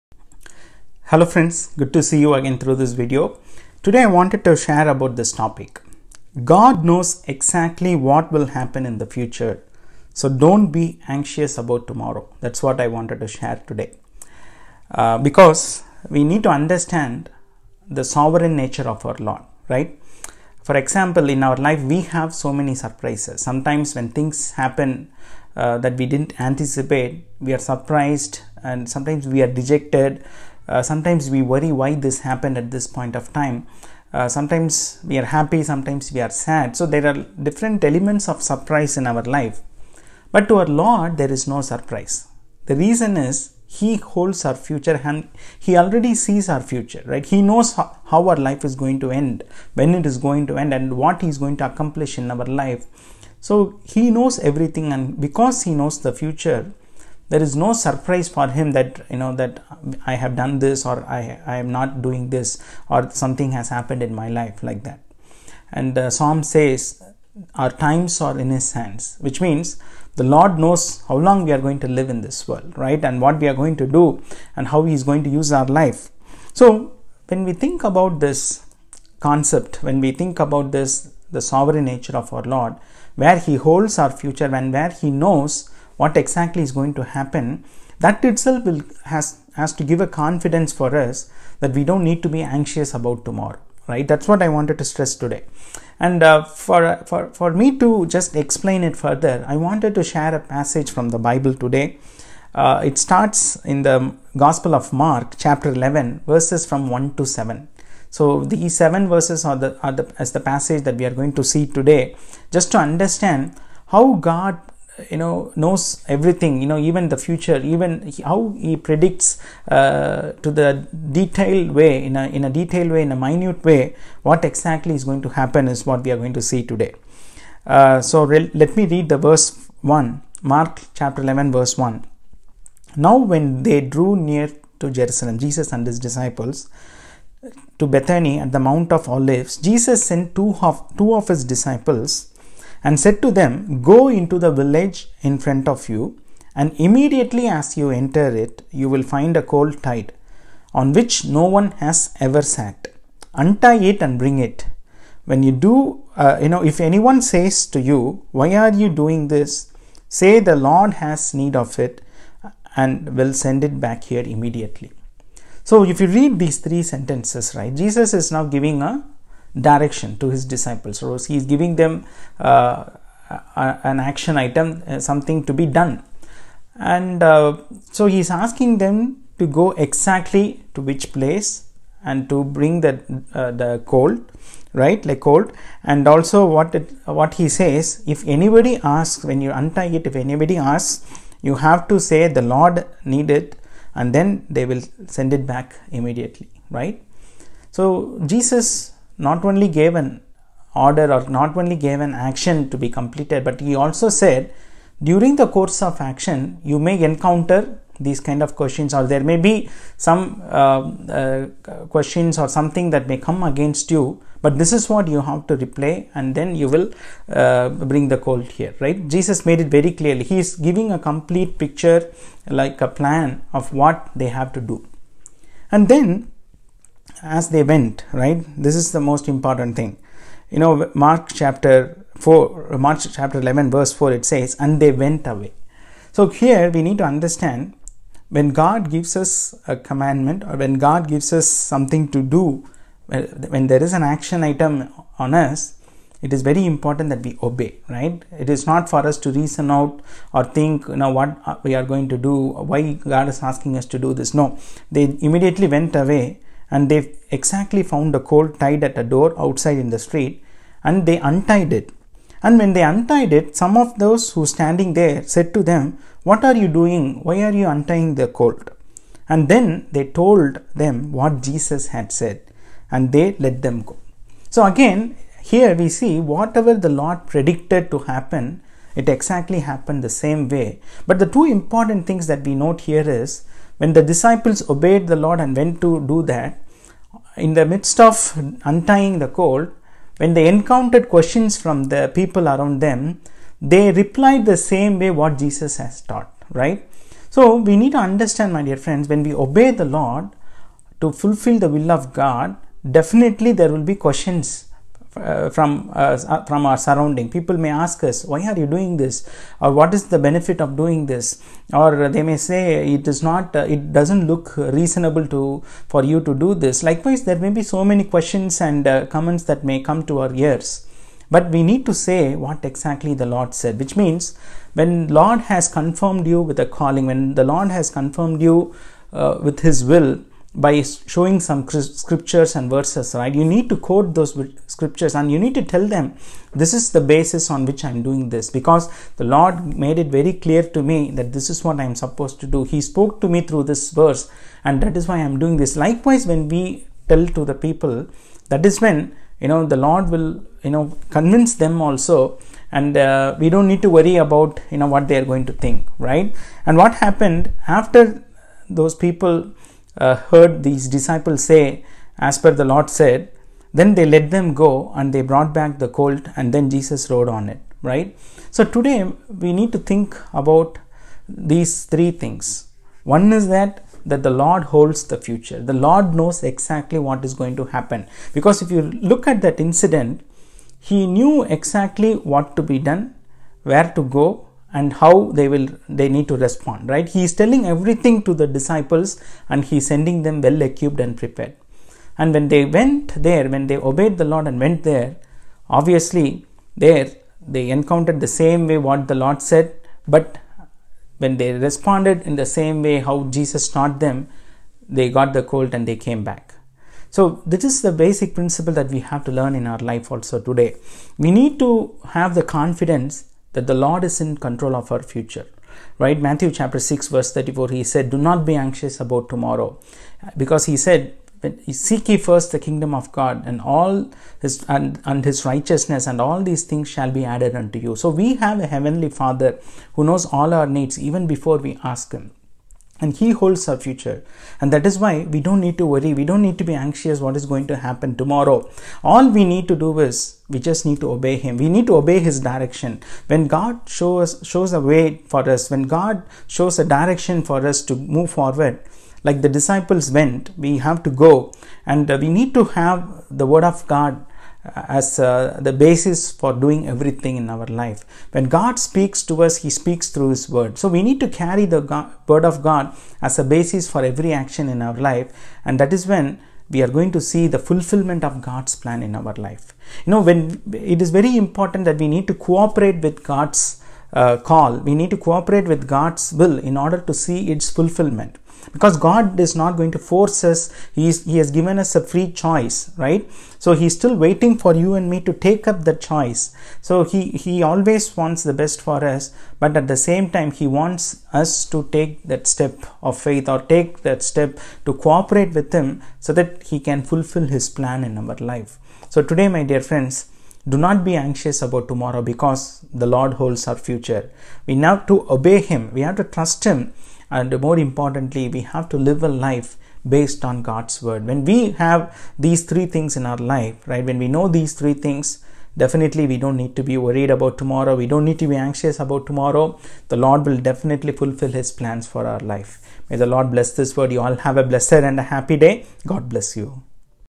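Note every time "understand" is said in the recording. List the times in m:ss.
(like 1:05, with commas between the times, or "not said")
0:16, 1:52, 3:57, 4:57.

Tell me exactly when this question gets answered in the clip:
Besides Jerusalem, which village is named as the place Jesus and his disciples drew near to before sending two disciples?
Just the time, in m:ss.
2:17.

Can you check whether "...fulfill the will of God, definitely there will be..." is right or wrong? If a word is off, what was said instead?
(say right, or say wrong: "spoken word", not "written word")
right.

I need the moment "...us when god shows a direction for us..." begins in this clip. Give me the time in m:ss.
7:25.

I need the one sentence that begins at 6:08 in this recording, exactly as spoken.
So today we need to think about these three things.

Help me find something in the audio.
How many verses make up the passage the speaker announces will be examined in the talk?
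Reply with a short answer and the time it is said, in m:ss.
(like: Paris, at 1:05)
7, at 1:48.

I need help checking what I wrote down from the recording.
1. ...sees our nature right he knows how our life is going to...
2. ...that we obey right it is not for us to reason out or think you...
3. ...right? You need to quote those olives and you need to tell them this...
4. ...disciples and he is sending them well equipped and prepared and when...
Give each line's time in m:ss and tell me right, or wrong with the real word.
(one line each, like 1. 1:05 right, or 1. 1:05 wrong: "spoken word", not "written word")
1. 0:46 wrong: "future", not "nature"
2. 4:07 right
3. 5:33 wrong: "scriptures", not "olives"
4. 6:28 right.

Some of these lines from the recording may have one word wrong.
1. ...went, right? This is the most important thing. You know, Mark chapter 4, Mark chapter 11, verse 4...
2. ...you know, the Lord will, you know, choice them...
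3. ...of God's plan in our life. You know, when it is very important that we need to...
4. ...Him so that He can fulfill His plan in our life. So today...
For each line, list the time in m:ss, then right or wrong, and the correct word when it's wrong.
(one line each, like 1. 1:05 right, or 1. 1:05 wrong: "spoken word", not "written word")
1. 3:47 right
2. 5:49 wrong: "convince", not "choice"
3. 7:48 right
4. 8:15 right.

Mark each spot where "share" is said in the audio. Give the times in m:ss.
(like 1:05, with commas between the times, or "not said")
0:04, 0:13, 1:40.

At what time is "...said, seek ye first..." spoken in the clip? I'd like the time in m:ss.
7:00.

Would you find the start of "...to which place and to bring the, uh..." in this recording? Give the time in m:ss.
3:00.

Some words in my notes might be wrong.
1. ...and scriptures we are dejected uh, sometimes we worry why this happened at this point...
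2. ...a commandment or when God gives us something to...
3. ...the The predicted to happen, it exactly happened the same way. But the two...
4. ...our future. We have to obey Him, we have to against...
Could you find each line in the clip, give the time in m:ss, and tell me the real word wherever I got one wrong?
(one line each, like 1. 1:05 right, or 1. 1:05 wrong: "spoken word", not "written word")
1. 0:28 wrong: "sometimes", not "scriptures"
2. 3:59 right
3. 4:36 wrong: "Lord", not "The"
4. 8:23 wrong: "trust", not "against".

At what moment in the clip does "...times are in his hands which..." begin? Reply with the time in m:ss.
1:07.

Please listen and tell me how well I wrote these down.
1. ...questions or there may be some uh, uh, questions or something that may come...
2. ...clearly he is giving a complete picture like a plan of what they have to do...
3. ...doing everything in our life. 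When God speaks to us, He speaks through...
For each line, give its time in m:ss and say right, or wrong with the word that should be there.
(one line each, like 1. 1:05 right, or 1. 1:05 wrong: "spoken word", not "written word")
1. 3:28 right
2. 3:39 right
3. 7:36 right.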